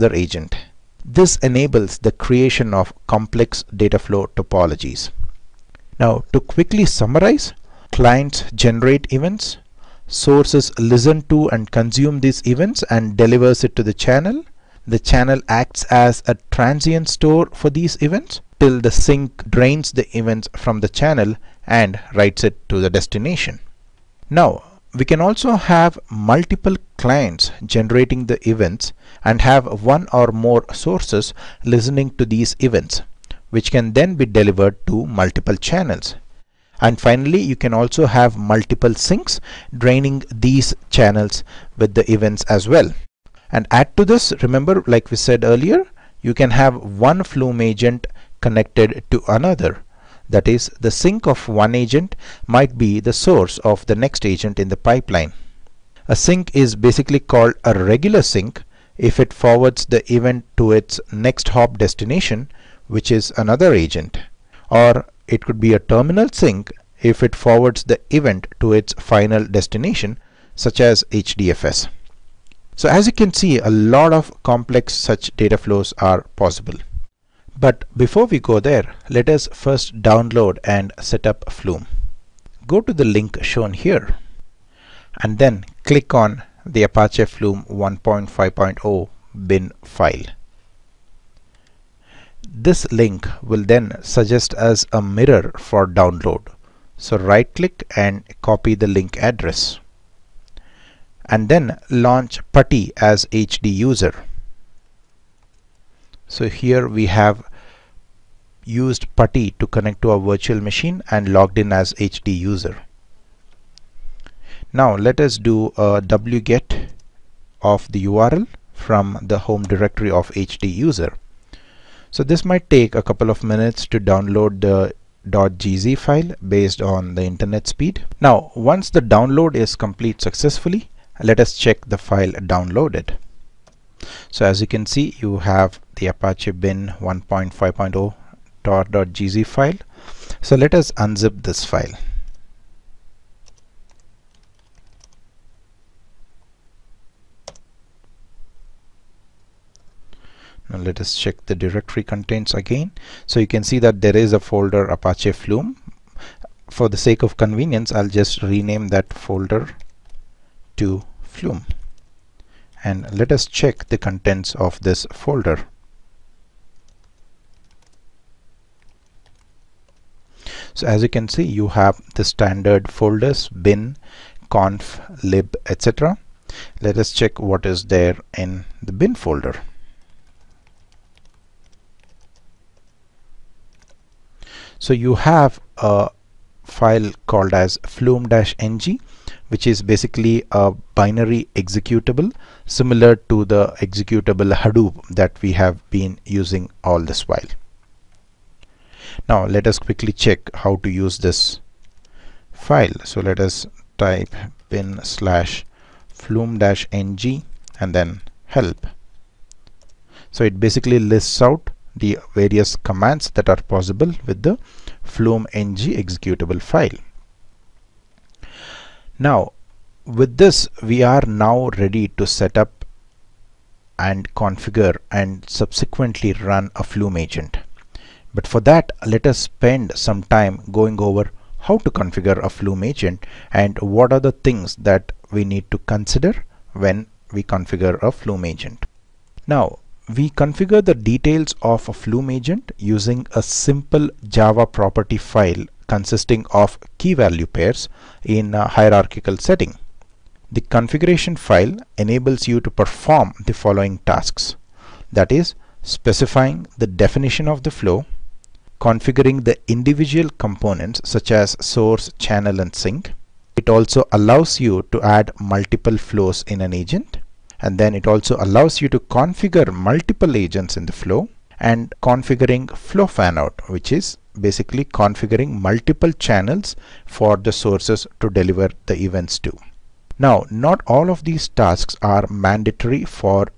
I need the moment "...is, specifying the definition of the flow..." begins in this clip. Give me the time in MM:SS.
04:15.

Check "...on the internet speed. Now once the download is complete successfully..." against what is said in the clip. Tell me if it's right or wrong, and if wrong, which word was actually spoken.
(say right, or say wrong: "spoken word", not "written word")
right.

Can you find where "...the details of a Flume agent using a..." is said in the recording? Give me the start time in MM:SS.
04:00.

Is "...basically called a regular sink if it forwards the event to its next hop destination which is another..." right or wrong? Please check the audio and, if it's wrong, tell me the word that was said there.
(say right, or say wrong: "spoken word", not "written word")
right.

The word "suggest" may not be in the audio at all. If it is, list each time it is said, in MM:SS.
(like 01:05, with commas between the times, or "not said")
01:33.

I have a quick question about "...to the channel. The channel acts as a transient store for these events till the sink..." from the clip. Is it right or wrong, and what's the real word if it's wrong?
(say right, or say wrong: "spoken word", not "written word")
right.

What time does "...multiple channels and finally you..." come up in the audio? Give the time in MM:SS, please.
00:35.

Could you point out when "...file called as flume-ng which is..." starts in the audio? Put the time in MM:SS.
03:06.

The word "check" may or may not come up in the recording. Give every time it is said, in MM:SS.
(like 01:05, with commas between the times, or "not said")
02:11, 02:31, 02:43, 02:57, 03:20.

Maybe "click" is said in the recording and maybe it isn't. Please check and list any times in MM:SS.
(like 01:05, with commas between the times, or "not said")
01:25, 01:37.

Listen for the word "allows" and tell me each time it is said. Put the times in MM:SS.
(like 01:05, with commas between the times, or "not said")
04:24, 04:28.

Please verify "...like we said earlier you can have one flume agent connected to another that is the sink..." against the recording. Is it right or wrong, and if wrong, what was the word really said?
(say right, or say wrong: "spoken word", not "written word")
right.